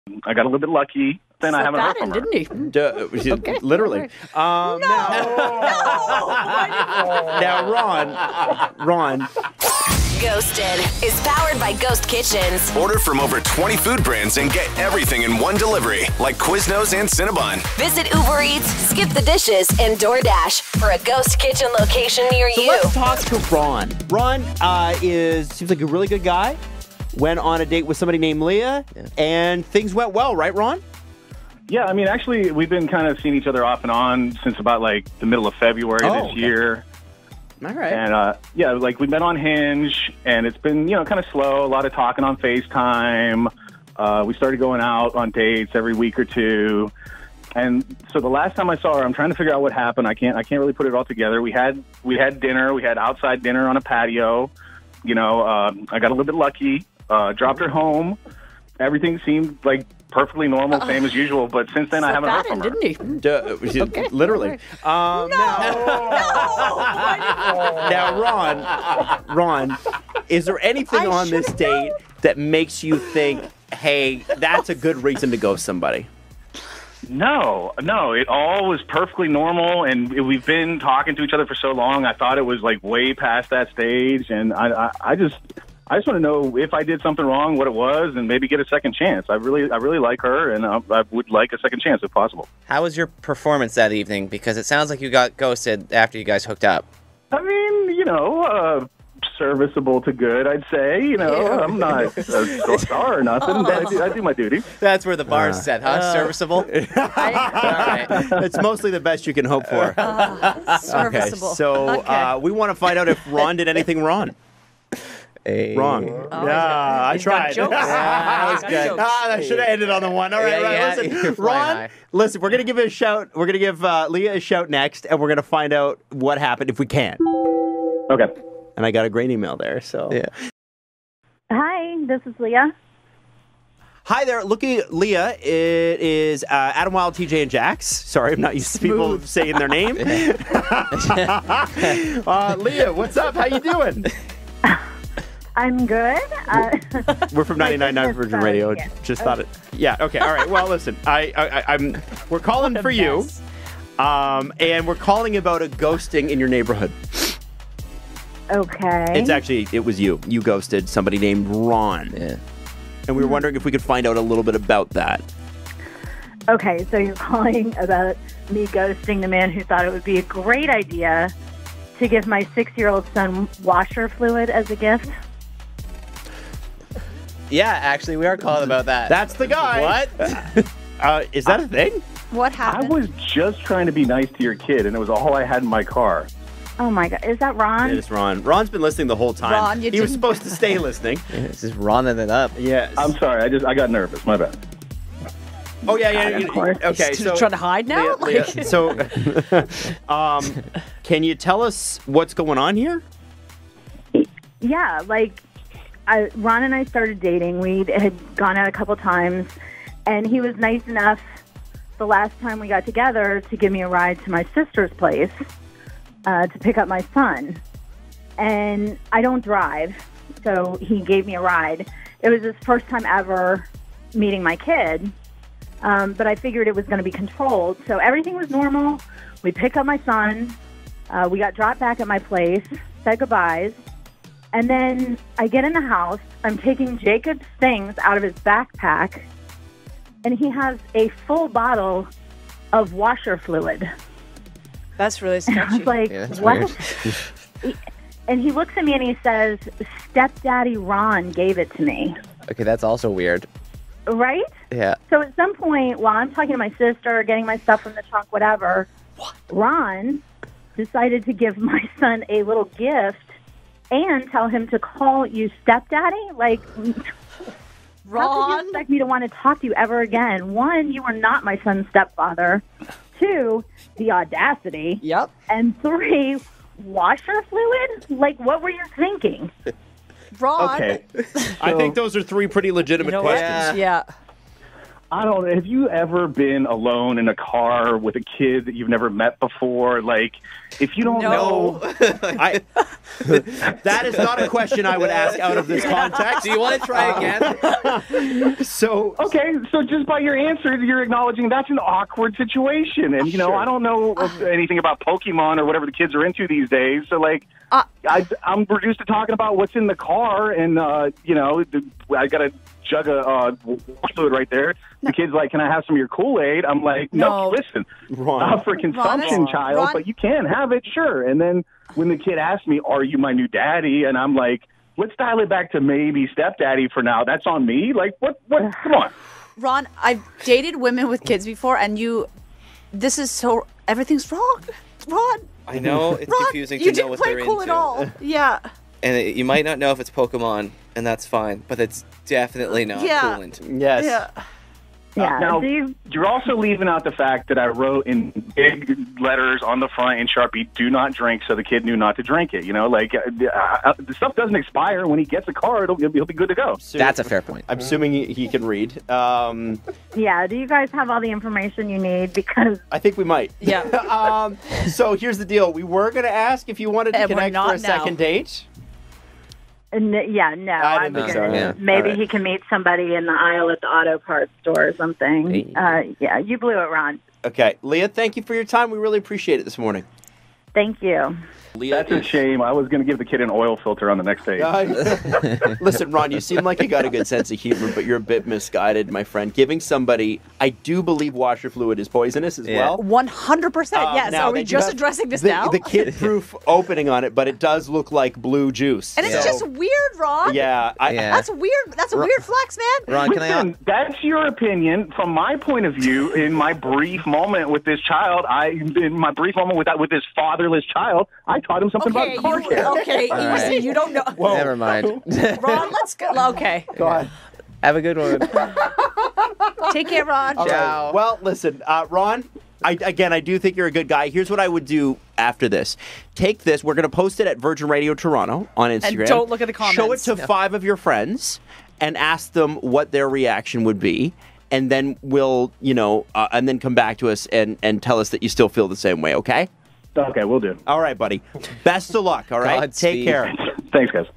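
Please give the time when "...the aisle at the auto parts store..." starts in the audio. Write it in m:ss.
6:13.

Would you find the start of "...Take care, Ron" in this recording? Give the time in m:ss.
6:59.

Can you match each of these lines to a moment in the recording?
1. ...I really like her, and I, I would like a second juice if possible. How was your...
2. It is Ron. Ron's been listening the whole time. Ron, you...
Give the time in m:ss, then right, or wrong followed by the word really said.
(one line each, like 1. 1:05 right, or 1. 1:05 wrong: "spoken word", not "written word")
1. 1:29 wrong: "chance", not "juice"
2. 3:07 right.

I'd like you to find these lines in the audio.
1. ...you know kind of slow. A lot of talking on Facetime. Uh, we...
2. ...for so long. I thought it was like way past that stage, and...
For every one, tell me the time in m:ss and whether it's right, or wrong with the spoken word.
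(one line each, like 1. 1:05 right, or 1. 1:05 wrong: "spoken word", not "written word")
1. 0:40 right
2. 1:21 right.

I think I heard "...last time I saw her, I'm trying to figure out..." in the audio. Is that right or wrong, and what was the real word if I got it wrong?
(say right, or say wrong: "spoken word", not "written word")
right.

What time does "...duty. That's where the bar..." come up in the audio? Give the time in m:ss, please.
1:44.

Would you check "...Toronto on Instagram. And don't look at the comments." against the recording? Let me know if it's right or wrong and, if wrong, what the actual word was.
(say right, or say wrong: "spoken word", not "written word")
right.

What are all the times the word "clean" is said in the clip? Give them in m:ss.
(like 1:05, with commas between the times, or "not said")
not said.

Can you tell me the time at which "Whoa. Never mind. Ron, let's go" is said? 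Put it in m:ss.
6:54.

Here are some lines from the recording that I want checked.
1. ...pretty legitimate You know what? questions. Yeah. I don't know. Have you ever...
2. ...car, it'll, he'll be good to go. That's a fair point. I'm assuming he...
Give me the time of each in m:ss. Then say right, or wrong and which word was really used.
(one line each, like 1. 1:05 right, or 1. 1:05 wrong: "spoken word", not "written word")
1. 4:42 right
2. 5:55 right.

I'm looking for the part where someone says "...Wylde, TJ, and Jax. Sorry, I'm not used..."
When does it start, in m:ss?
2:16.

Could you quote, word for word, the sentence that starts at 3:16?
You, okay, He's so trying to hide now.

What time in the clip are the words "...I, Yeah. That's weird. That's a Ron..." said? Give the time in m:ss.
6:40.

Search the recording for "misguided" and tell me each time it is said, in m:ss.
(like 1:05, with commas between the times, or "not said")
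6:28.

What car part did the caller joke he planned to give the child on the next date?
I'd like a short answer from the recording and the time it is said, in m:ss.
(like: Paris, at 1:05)
Oil filter, at 6:23.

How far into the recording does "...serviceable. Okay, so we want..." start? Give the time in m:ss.
1:50.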